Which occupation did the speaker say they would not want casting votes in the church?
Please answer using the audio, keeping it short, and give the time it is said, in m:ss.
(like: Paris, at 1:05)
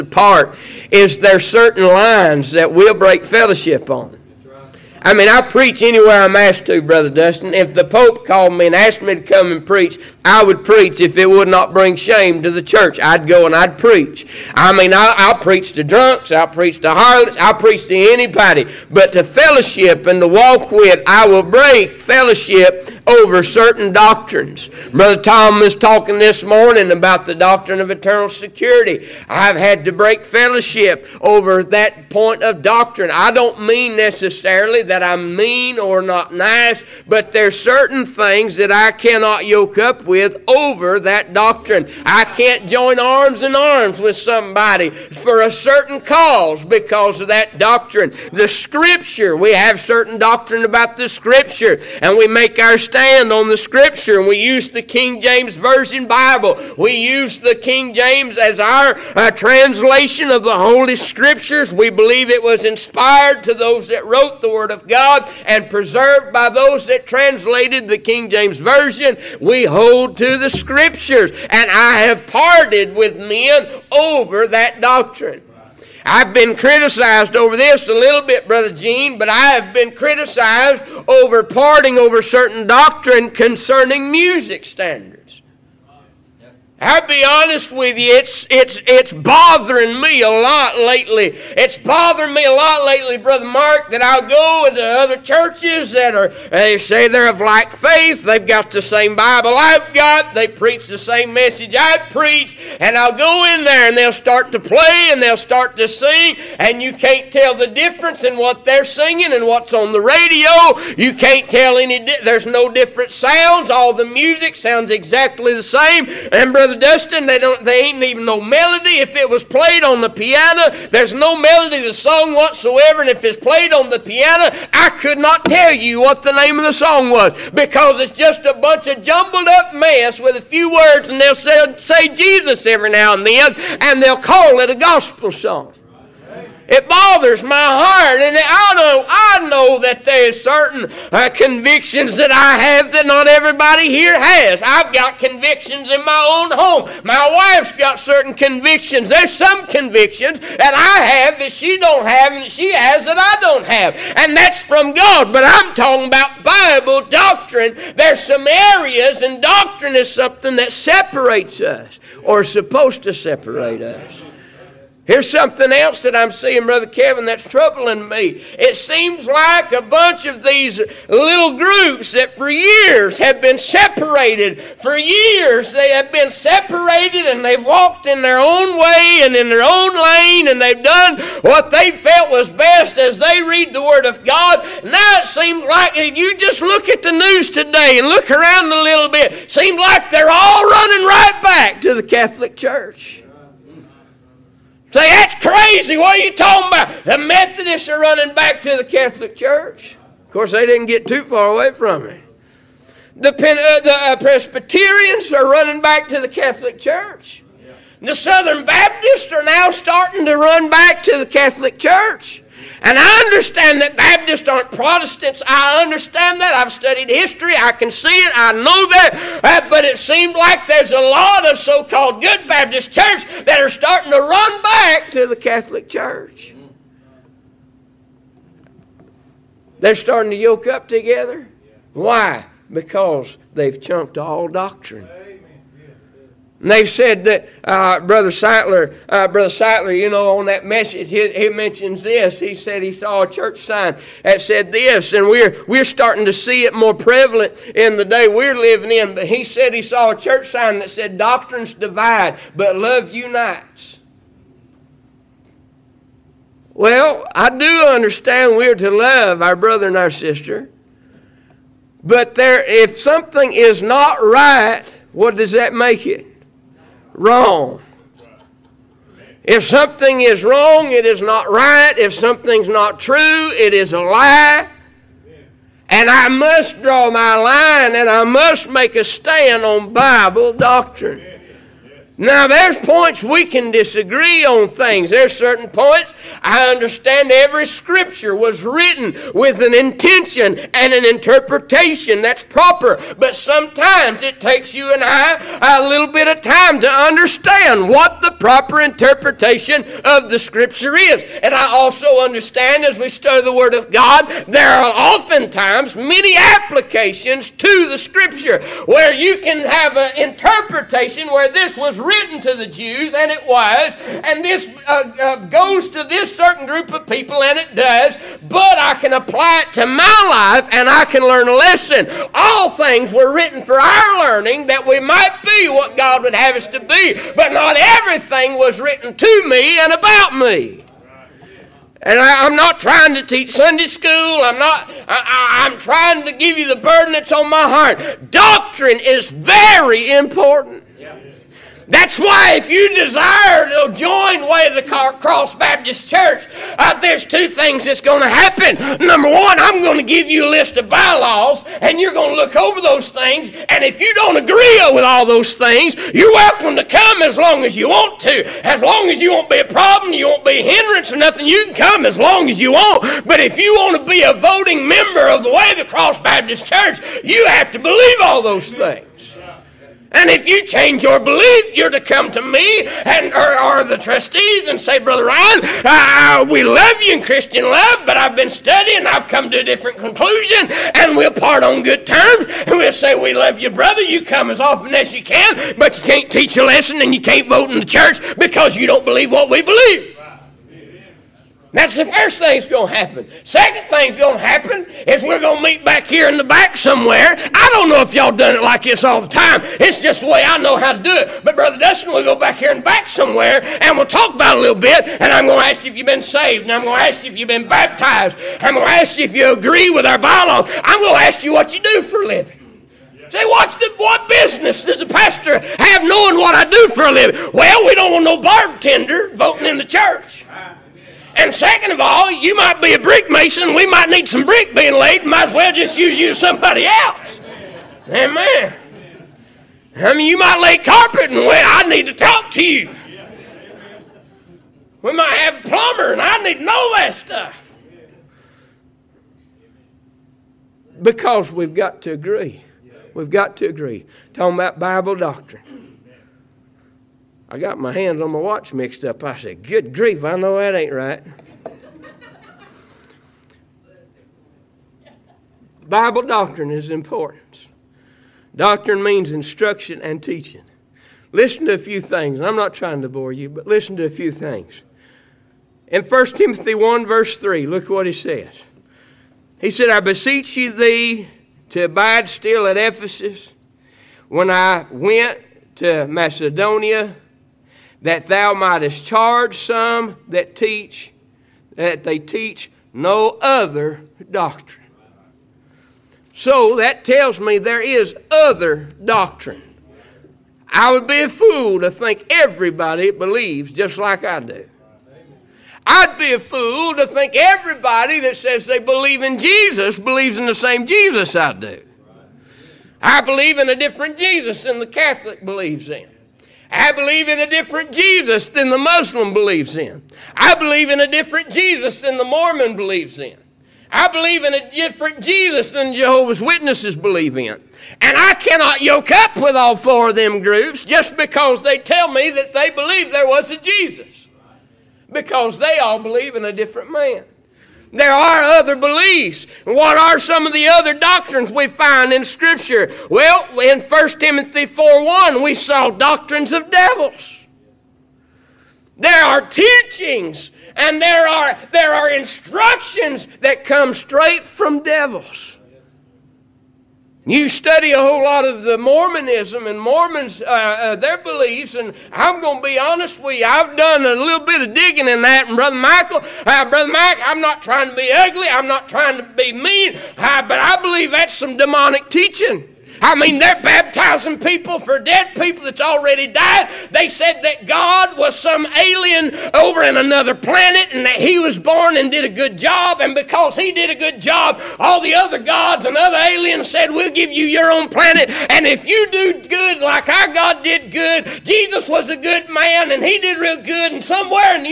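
bartender, at 6:58.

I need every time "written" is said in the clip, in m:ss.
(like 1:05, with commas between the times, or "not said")
4:48, 5:12, 5:23, 5:28.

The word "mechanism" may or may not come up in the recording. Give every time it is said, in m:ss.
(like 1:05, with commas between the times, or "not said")
not said.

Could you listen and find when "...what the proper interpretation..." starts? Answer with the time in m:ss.
4:57.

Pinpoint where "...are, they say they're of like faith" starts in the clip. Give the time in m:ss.
1:36.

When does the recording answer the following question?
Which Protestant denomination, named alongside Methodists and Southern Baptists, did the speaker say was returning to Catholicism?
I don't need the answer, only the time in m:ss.
3:24.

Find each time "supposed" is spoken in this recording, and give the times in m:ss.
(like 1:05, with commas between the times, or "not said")
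2:42.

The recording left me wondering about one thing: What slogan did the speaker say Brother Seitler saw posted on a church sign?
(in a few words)
Doctrines divide, but love unites.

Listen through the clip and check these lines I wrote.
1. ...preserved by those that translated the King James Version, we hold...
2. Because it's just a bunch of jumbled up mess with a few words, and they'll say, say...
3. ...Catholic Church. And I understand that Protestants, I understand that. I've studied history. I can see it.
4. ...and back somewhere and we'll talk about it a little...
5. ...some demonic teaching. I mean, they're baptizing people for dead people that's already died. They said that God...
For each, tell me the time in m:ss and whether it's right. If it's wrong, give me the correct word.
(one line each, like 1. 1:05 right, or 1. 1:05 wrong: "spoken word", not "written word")
1. 1:05 right
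2. 2:07 right
3. 3:31 right
4. 6:42 right
5. 9:21 right.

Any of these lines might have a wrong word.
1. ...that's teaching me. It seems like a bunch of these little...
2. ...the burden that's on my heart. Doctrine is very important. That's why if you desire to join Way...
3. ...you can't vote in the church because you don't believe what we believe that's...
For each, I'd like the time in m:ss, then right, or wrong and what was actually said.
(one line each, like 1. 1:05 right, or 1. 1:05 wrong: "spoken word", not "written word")
1. 2:47 wrong: "troubling", not "teaching"
2. 5:36 right
3. 6:27 right.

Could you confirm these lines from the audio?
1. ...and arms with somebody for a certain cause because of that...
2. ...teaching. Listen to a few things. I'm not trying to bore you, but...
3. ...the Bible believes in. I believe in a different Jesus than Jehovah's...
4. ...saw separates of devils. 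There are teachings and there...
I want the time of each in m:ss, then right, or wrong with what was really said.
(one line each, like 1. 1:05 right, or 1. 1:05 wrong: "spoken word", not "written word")
1. 0:43 right
2. 7:40 right
3. 8:32 wrong: "Mormon", not "Bible"
4. 8:55 wrong: "doctrines", not "separates".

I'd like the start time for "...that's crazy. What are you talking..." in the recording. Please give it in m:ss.
3:15.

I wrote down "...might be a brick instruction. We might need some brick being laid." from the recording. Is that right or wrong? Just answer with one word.
wrong.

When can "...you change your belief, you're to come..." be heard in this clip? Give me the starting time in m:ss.
6:10.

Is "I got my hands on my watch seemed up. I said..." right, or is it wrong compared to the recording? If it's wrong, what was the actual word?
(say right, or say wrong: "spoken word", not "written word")
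wrong: "mixed", not "seemed".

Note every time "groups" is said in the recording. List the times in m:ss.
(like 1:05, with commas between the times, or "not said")
2:51, 5:16, 8:40.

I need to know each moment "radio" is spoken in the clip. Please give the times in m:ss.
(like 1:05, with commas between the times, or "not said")
1:50.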